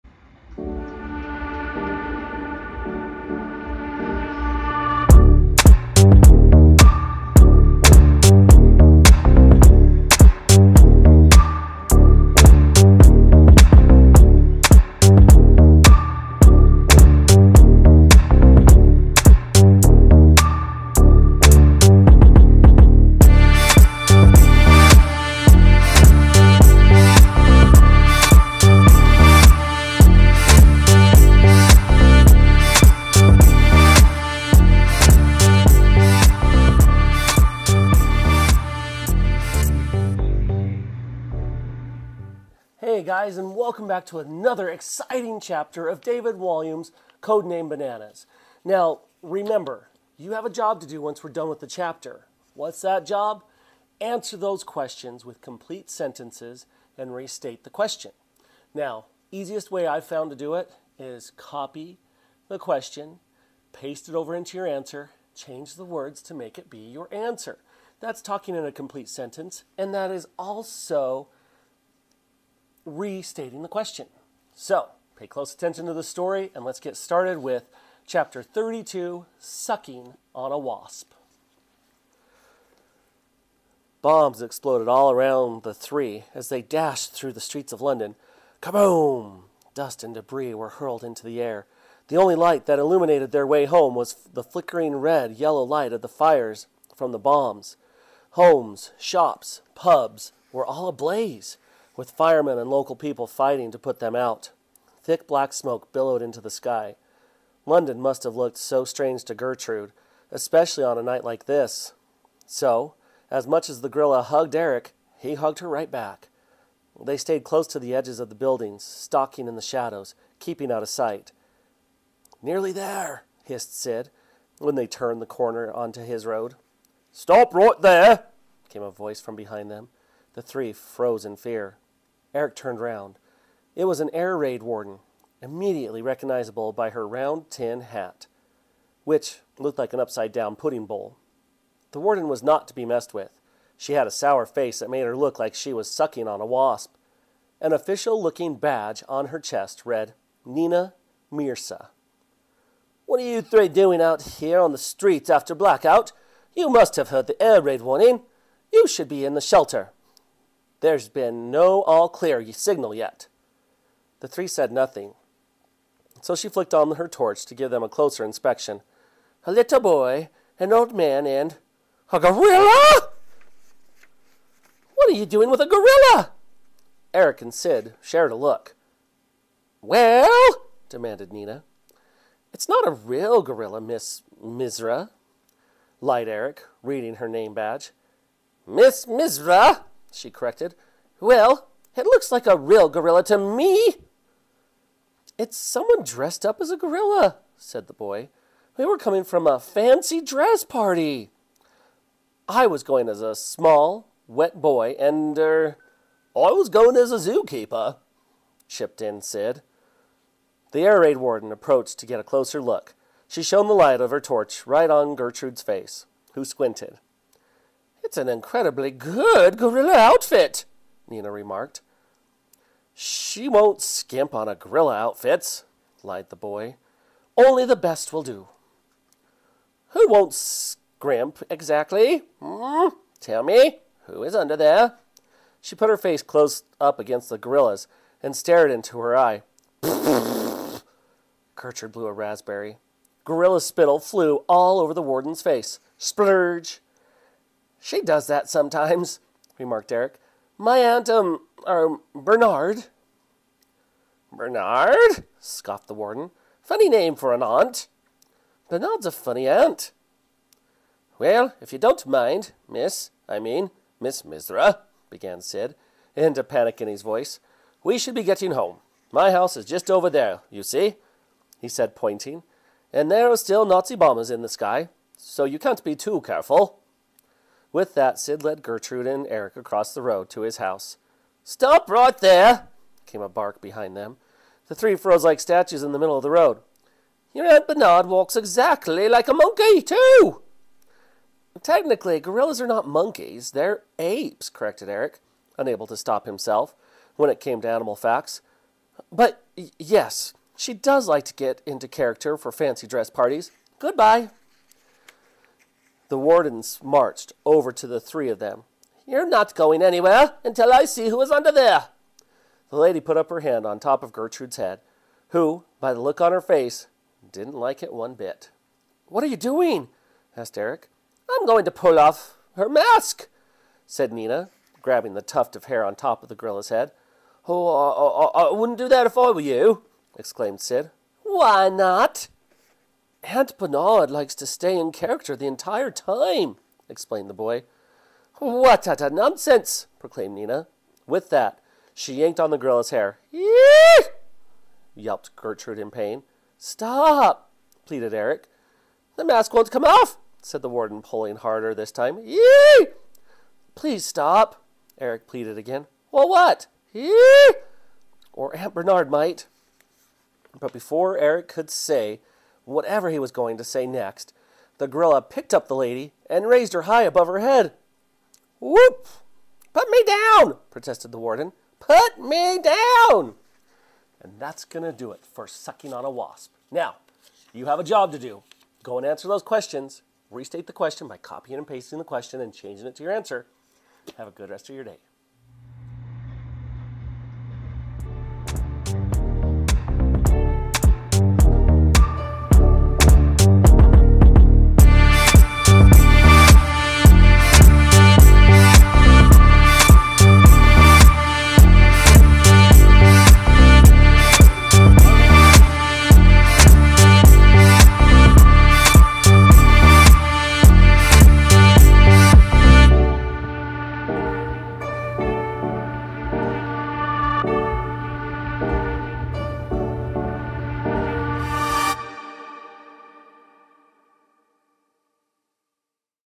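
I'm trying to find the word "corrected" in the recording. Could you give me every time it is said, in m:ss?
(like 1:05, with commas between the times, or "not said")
3:10, 4:54.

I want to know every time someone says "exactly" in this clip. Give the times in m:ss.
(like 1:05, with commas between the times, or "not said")
3:51, 4:48.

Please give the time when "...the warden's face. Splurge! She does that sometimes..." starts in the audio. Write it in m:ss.
4:04.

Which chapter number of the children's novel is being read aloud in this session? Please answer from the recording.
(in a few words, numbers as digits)
32.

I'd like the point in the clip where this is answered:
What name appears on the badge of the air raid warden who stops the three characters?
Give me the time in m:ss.
2:30.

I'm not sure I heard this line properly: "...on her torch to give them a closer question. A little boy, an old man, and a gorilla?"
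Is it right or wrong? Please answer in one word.
wrong.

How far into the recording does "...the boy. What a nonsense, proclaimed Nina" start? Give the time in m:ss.
5:37.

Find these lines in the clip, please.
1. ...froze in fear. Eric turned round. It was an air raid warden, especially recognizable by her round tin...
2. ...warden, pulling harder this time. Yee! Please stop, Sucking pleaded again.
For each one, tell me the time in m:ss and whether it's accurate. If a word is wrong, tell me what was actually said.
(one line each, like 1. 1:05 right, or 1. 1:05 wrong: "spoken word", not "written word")
1. 2:10 wrong: "immediately", not "especially"
2. 5:50 wrong: "Eric", not "Sucking".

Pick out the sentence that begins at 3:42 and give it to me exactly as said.
She won't skimp on a gorilla outfit, lied the boy.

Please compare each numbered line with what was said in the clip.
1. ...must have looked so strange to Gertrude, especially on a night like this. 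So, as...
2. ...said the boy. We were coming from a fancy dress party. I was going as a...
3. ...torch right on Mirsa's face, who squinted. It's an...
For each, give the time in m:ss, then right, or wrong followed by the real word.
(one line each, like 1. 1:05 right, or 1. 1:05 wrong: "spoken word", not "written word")
1. 1:48 right
2. 3:17 right
3. 3:34 wrong: "Gertrude", not "Mirsa".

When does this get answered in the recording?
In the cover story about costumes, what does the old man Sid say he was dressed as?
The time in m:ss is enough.
3:27.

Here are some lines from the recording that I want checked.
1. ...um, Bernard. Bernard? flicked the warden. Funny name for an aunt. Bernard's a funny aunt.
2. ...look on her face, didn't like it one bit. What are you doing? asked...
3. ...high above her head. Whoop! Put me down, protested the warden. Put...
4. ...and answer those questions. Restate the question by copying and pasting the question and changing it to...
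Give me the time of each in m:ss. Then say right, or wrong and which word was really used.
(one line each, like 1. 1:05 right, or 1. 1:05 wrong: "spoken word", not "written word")
1. 4:11 wrong: "scoffed", not "flicked"
2. 5:16 right
3. 6:06 right
4. 6:18 right.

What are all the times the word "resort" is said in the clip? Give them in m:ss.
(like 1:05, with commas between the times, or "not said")
not said.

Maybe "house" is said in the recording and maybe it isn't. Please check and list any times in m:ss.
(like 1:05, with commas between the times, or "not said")
4:29, 4:40.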